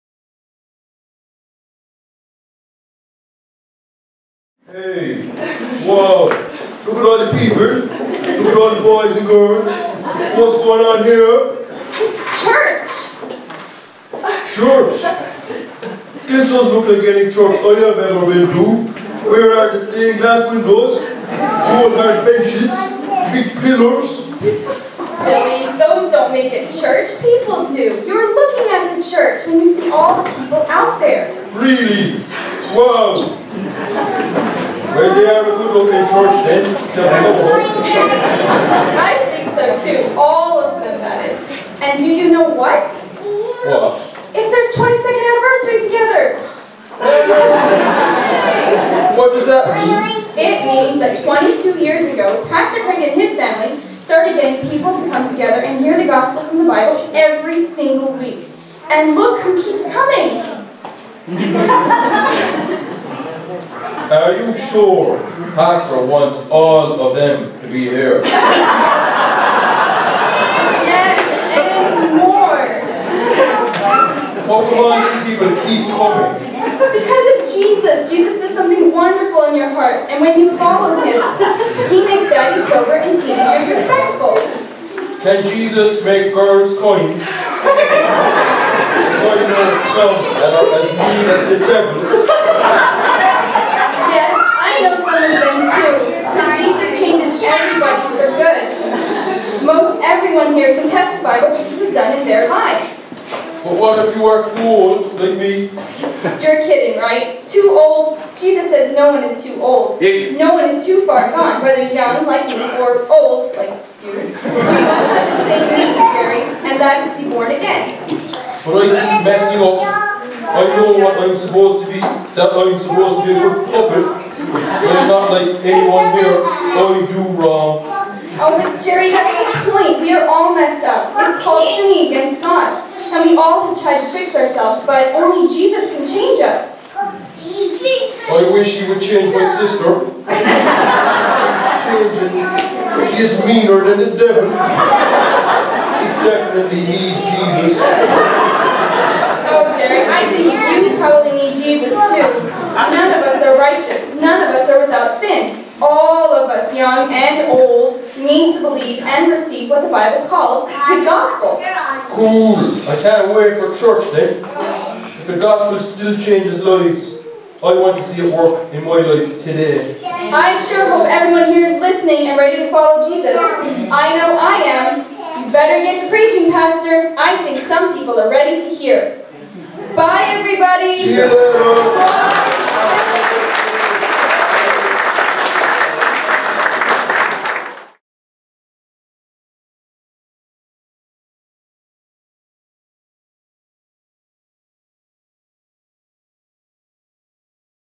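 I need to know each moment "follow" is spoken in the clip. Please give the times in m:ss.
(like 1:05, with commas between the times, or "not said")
1:20, 2:52.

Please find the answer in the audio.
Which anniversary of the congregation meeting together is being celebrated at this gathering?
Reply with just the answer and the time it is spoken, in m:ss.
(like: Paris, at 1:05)
22nd, at 0:44.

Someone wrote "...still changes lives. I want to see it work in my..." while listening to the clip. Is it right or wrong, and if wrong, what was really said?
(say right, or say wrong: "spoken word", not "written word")
right.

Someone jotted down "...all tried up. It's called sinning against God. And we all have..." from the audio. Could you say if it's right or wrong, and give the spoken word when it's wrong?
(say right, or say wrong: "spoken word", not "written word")
wrong: "messed", not "tried".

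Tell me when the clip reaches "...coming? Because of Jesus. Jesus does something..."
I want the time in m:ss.
1:15.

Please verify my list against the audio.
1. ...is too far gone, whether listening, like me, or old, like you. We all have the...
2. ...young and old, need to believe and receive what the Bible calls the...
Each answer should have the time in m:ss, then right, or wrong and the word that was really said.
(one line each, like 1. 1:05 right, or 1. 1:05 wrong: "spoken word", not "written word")
1. 1:50 wrong: "young", not "listening"
2. 2:36 right.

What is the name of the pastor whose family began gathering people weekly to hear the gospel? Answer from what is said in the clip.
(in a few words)
Craig.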